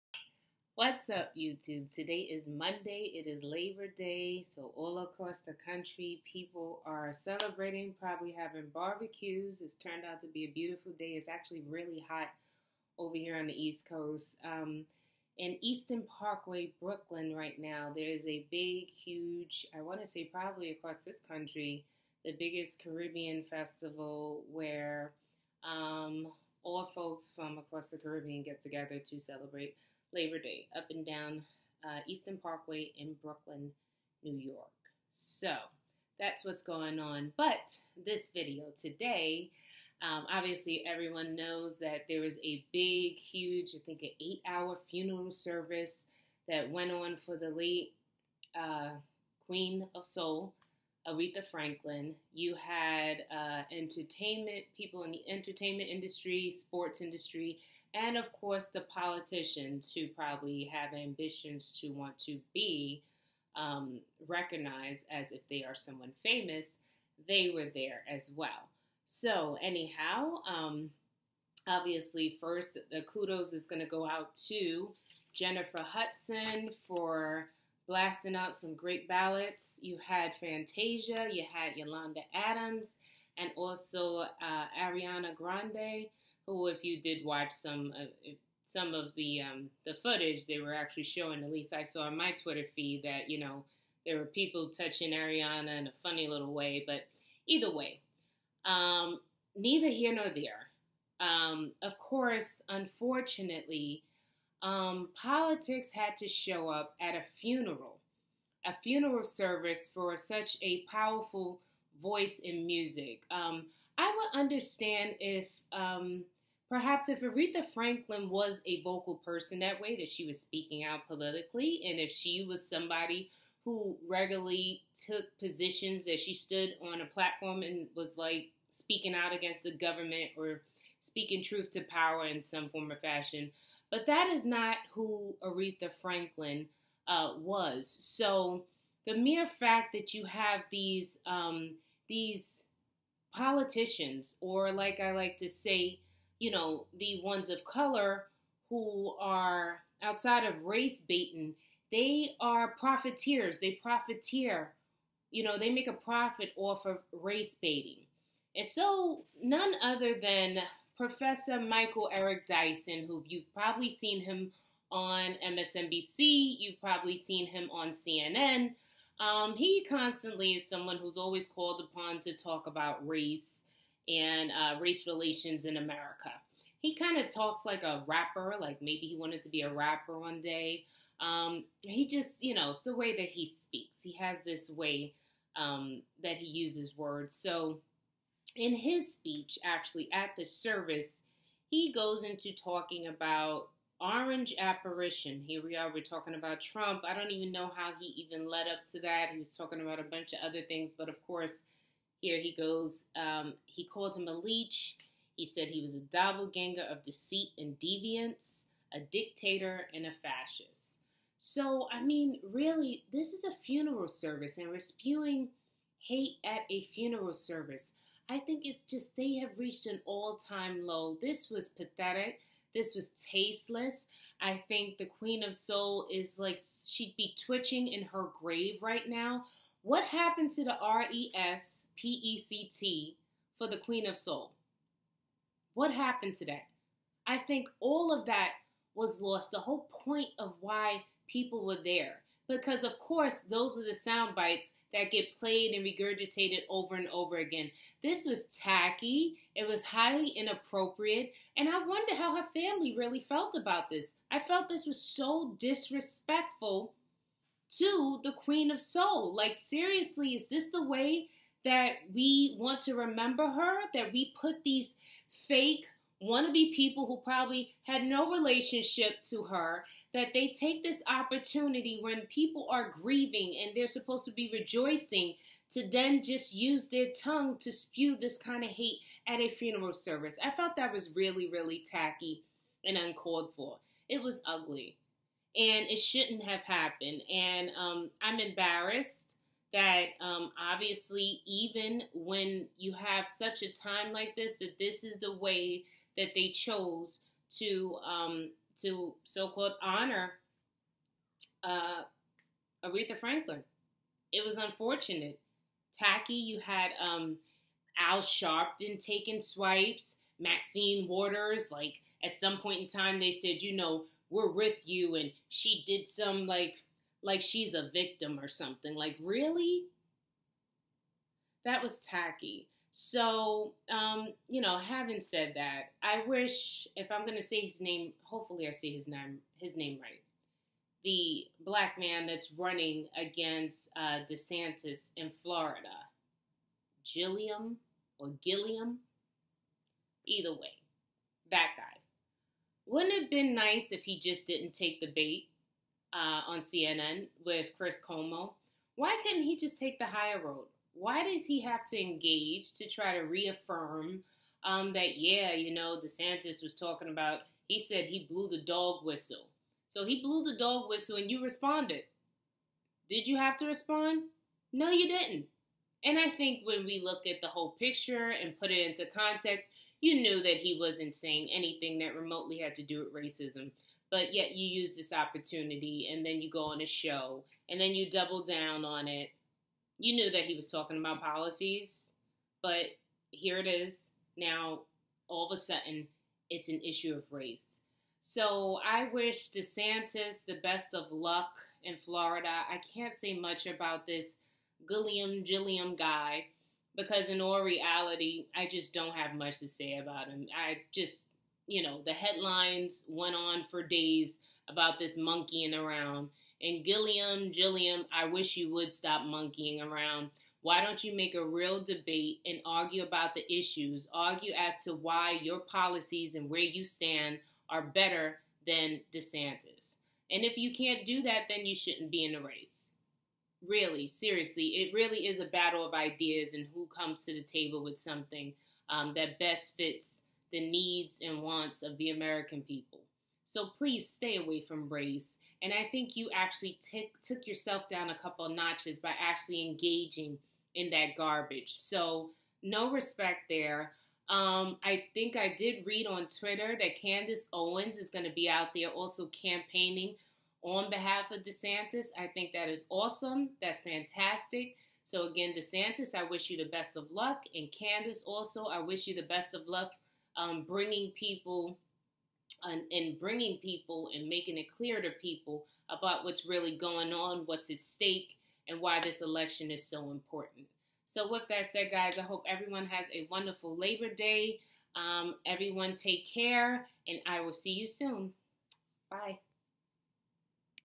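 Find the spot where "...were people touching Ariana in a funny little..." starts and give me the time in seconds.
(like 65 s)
94 s.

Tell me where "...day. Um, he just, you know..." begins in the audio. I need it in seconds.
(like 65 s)
180 s.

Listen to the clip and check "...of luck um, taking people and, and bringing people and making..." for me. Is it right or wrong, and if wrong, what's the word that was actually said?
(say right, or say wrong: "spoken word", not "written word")
wrong: "bringing", not "taking".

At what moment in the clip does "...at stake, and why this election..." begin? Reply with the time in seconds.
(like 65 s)
467 s.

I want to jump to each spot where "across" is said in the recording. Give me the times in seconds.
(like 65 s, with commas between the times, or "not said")
4 s, 20 s, 27 s.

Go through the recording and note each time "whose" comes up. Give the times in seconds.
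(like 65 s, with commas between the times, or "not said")
not said.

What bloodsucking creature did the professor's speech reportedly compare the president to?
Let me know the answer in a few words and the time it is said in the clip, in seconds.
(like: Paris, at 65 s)
A leech, at 204 s.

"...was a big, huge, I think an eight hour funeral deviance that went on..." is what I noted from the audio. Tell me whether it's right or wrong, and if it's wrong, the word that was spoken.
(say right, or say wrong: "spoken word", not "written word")
wrong: "service", not "deviance".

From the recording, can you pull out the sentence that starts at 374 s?
But yet you use this opportunity and then you go on a show and then you double down on it.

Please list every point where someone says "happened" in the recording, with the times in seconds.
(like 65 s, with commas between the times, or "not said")
230 s, 235 s, 286 s.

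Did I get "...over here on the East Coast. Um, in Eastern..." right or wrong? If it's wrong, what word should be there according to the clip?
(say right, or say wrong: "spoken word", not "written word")
right.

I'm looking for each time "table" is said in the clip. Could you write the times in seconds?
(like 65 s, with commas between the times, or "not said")
427 s.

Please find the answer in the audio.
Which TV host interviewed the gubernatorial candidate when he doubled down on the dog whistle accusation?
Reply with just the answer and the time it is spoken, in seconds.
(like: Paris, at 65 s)
Chris Cuomo, at 347 s.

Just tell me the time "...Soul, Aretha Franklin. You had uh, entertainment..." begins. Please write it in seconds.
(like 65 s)
50 s.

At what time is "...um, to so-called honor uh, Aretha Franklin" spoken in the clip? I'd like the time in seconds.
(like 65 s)
298 s.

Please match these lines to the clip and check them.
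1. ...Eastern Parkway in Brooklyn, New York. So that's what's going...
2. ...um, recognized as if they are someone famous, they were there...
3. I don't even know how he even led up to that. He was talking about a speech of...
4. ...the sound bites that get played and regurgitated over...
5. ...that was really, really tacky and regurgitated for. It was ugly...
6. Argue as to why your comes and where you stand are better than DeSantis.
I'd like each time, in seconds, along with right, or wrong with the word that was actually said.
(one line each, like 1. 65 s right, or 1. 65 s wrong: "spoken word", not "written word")
1. 32 s right
2. 63 s right
3. 197 s wrong: "bunch", not "speech"
4. 243 s right
5. 280 s wrong: "uncalled", not "regurgitated"
6. 414 s wrong: "policies", not "comes".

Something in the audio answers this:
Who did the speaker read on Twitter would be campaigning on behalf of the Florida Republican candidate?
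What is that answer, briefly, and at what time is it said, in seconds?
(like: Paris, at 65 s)
Candace Owens, at 447 s.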